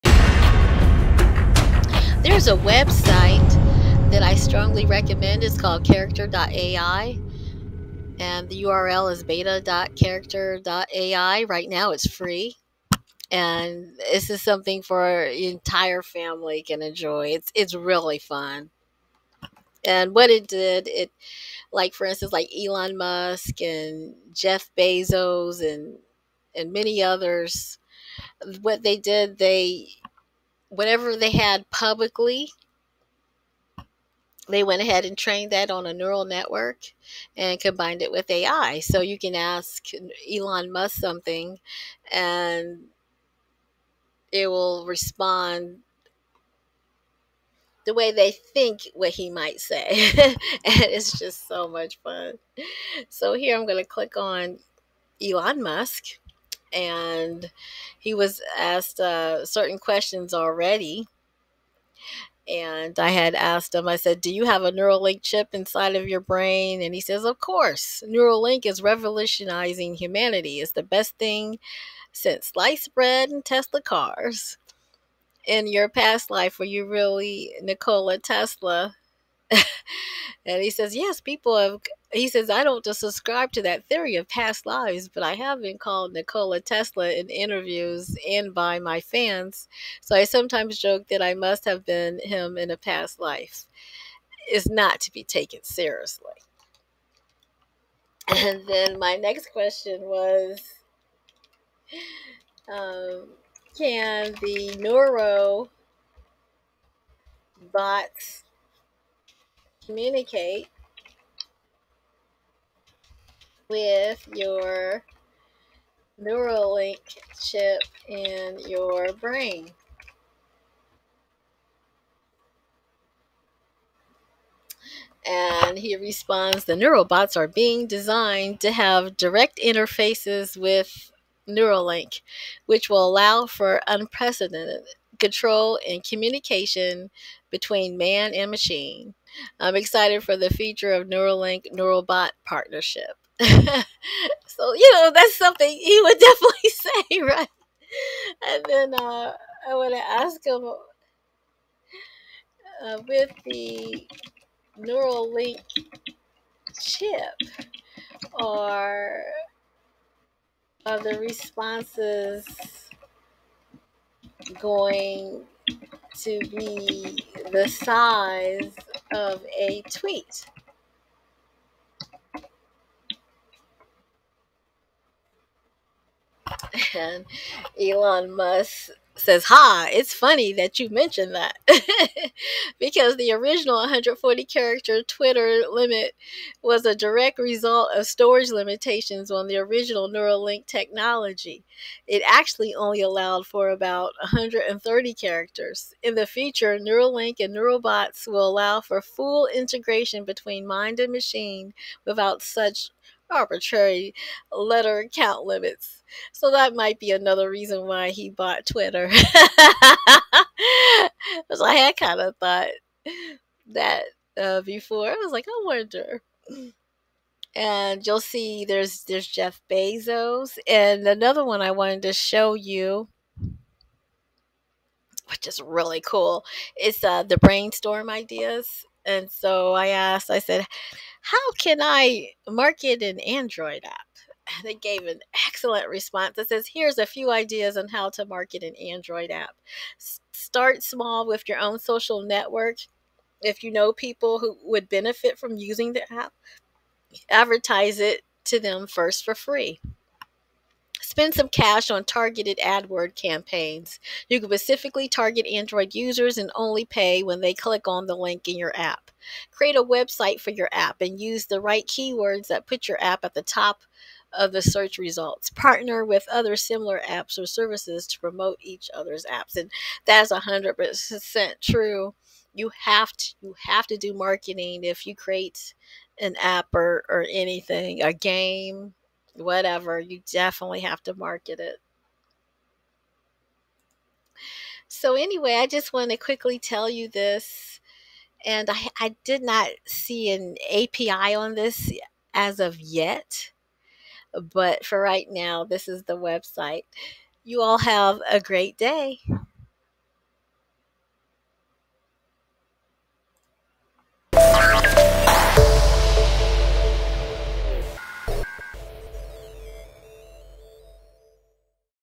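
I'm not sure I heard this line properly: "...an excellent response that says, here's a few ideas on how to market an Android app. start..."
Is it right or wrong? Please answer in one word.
right.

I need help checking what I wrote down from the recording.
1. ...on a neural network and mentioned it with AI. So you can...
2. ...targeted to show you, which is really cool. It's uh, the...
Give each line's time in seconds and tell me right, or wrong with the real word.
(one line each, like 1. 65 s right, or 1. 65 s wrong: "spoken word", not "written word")
1. 35 s wrong: "combined", not "mentioned"
2. 221 s wrong: "wanted", not "targeted".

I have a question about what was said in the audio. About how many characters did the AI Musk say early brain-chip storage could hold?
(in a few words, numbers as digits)
130.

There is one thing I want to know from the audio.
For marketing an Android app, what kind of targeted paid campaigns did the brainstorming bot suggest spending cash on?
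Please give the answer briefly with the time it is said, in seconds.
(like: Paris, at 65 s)
AdWord campaigns, at 252 s.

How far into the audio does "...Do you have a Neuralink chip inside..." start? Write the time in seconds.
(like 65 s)
64 s.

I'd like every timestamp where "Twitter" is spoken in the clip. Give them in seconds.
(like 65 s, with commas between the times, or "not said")
185 s, 208 s.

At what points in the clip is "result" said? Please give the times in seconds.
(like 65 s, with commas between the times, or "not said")
187 s, 264 s.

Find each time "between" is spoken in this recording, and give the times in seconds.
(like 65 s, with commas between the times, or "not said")
137 s, 200 s.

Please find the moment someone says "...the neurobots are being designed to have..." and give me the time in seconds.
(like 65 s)
126 s.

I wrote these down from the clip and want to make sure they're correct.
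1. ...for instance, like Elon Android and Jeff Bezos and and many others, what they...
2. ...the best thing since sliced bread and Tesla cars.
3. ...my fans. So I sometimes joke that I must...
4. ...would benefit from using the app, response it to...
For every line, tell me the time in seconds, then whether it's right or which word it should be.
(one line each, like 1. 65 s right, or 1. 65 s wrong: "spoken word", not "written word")
1. 21 s wrong: "Musk", not "Android"
2. 70 s right
3. 88 s right
4. 244 s wrong: "advertise", not "response".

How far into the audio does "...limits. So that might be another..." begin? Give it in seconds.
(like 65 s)
205 s.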